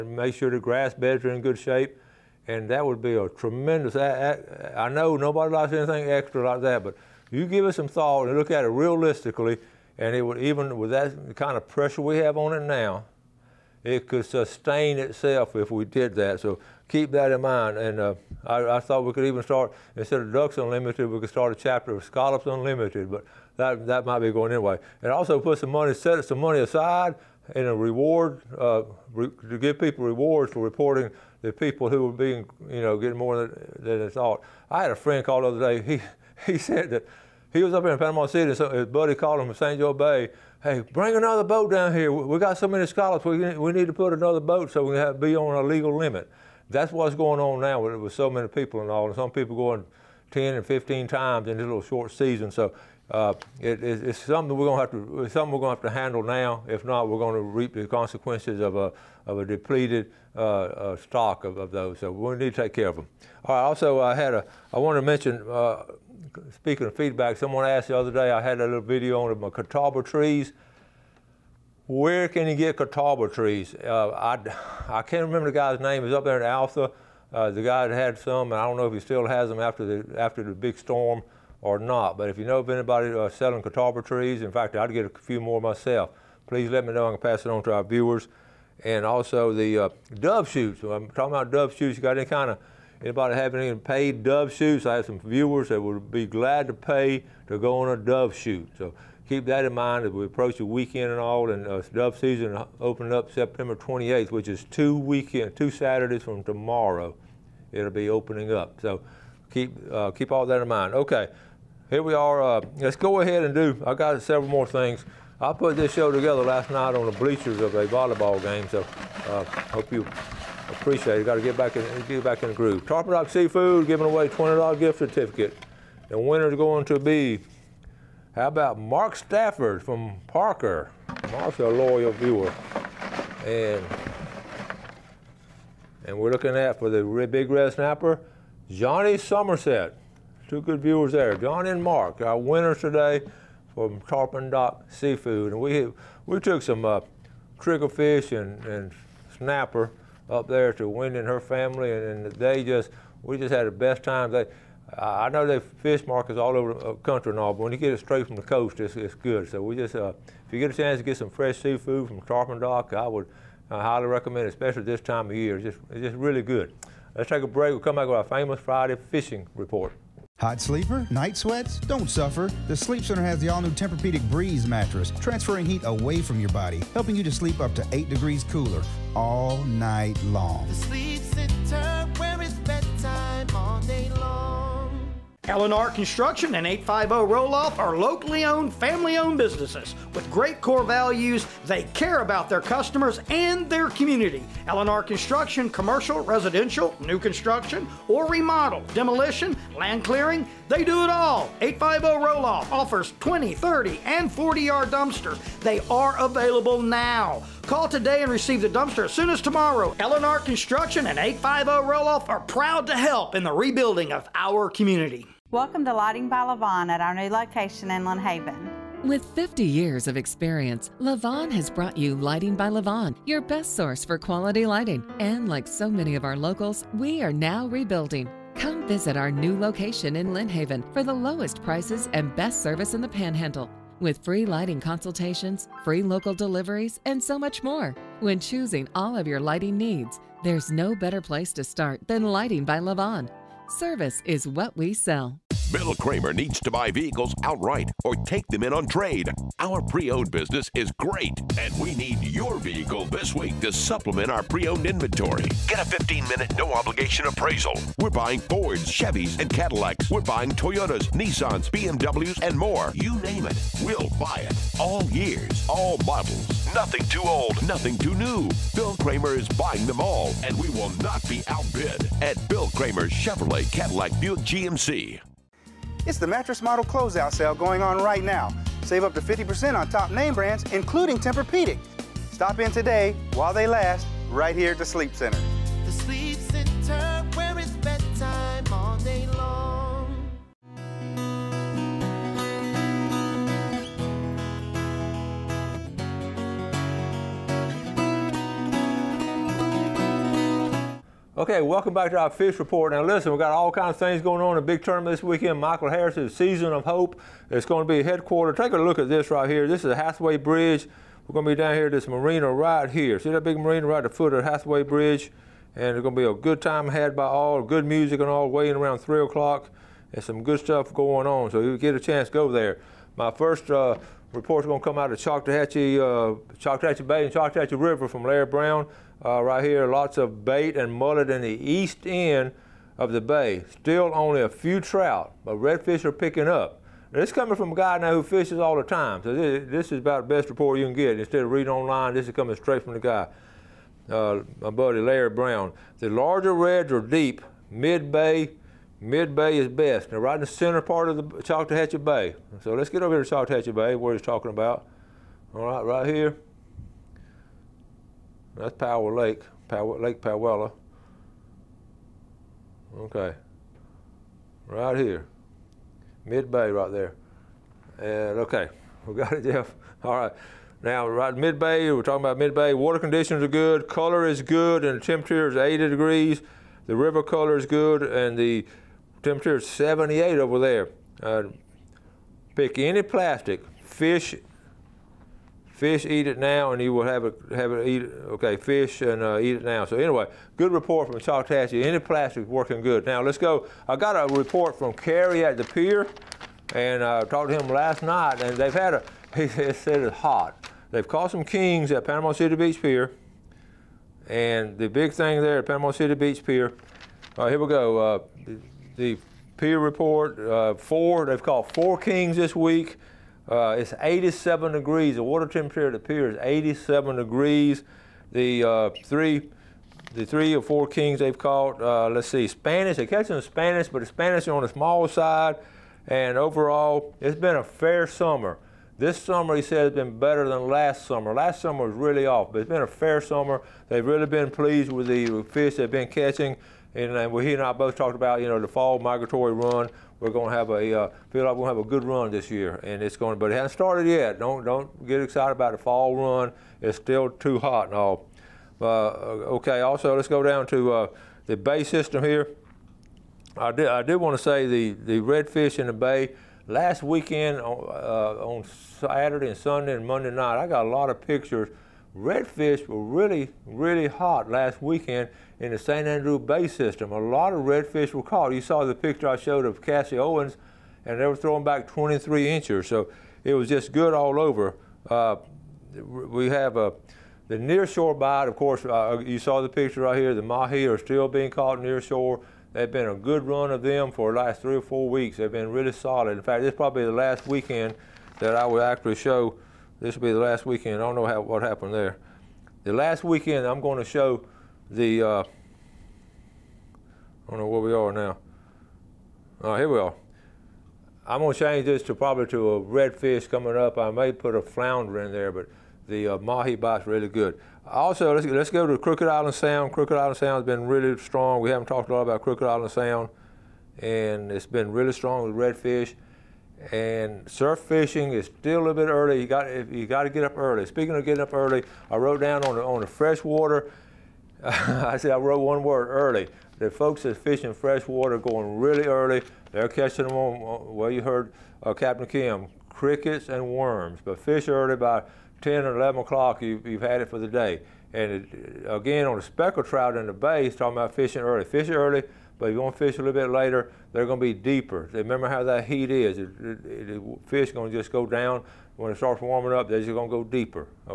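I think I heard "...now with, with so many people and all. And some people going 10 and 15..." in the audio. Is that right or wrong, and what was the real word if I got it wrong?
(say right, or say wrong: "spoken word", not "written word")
right.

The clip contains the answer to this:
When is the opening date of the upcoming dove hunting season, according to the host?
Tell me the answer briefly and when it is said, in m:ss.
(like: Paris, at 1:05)
September 28th, at 1:43.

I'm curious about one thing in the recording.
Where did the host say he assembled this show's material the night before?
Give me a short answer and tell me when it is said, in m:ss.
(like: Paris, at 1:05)
a volleyball game, at 1:57.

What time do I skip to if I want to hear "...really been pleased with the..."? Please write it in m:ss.
7:14.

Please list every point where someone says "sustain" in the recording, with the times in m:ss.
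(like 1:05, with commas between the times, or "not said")
0:14.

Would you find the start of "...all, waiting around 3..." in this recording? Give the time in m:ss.
5:18.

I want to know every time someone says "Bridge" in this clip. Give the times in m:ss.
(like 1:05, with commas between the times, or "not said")
5:10, 5:14.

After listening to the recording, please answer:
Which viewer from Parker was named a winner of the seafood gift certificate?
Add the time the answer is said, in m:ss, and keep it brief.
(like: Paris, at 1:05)
Mark Stafford, at 2:08.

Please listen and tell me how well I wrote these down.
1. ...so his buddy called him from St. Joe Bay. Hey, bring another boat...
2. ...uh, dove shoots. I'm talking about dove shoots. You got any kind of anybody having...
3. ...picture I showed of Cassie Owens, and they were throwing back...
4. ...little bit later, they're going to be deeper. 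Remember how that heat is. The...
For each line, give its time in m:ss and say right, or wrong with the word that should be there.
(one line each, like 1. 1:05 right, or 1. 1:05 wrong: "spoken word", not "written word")
1. 0:38 right
2. 1:29 right
3. 7:48 right
4. 9:03 right.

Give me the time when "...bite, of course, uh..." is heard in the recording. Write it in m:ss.
7:58.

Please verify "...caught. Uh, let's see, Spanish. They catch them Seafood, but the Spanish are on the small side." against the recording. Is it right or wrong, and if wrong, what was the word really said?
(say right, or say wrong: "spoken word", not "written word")
wrong: "Spanish", not "Seafood".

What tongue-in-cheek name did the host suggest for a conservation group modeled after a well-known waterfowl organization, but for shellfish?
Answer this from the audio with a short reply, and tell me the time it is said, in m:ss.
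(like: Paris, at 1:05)
Scallops Unlimited, at 0:22.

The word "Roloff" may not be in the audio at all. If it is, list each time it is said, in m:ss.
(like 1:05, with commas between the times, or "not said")
3:07, 3:22, 3:31.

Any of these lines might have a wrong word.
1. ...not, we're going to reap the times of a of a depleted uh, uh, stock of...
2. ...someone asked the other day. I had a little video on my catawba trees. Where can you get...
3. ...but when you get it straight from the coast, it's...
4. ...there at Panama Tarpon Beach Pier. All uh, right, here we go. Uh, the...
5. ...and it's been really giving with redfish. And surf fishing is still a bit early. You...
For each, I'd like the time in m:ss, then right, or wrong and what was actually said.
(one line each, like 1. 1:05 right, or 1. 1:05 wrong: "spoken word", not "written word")
1. 0:56 wrong: "consequences", not "times"
2. 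1:07 right
3. 2:37 right
4. 6:45 wrong: "City", not "Tarpon"
5. 8:33 wrong: "strong", not "giving".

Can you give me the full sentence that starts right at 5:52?
So let's get over here to Choctawhatchee Bay, where he's talking about.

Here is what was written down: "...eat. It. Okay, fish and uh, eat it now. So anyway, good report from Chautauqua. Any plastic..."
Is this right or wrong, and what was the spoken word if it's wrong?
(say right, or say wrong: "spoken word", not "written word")
right.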